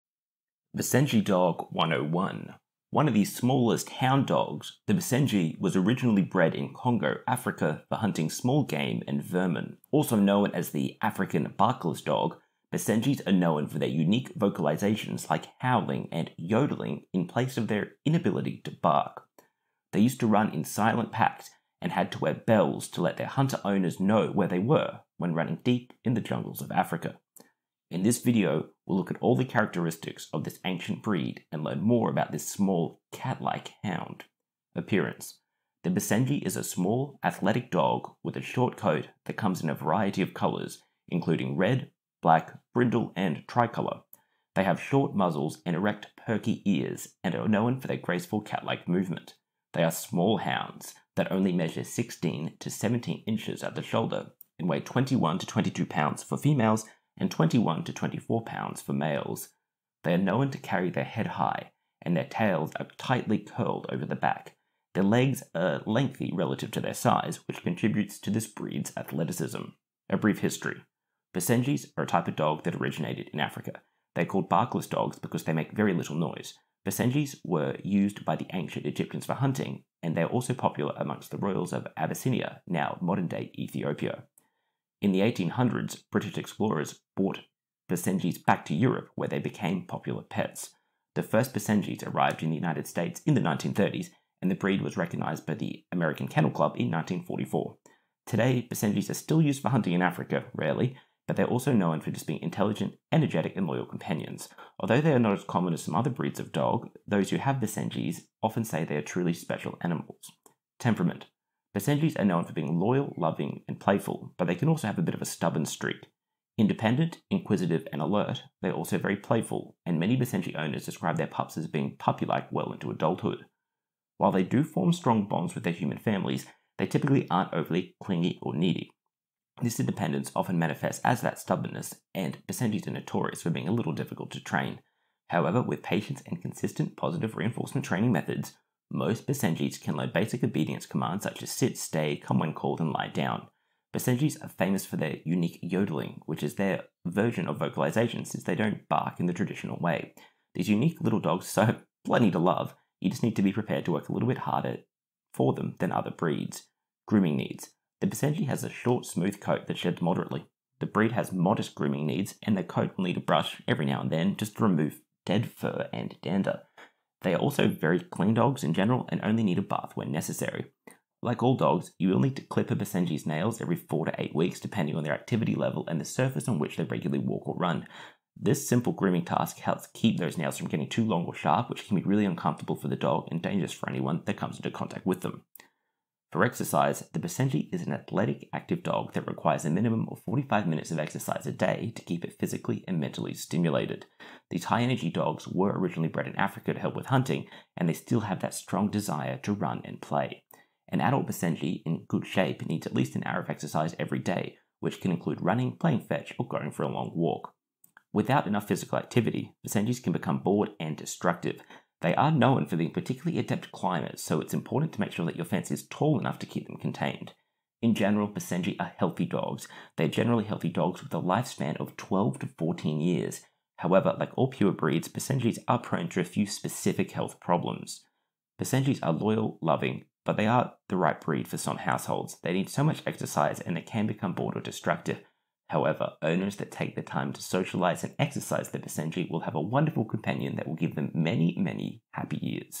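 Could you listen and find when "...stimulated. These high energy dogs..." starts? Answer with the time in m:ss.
3:13.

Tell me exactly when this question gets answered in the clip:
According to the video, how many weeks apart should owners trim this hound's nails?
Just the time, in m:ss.
2:53.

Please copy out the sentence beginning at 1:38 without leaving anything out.
Today, Basenjis are still used for hunting in Africa, rarely, but they're also known for just being intelligent, energetic, and loyal companions.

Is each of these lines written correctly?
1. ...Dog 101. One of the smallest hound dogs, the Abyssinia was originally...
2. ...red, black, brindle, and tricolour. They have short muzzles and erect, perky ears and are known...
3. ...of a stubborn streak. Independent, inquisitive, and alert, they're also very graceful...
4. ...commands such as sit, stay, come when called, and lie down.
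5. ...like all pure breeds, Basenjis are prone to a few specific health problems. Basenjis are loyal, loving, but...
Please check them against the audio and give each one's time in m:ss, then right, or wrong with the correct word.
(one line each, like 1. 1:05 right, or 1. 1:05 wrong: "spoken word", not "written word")
1. 0:01 wrong: "Basenji", not "Abyssinia"
2. 0:41 right
3. 1:55 wrong: "playful", not "graceful"
4. 2:20 right
5. 3:44 right.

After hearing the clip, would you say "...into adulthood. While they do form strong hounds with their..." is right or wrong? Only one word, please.
wrong.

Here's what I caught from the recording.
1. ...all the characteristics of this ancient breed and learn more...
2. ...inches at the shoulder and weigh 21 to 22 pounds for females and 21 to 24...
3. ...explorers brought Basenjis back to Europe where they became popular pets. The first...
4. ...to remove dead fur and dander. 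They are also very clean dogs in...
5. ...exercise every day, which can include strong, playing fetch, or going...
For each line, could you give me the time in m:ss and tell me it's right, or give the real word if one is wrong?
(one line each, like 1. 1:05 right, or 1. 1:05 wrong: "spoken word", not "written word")
1. 0:29 right
2. 0:53 right
3. 1:26 right
4. 2:44 right
5. 3:23 wrong: "running", not "strong".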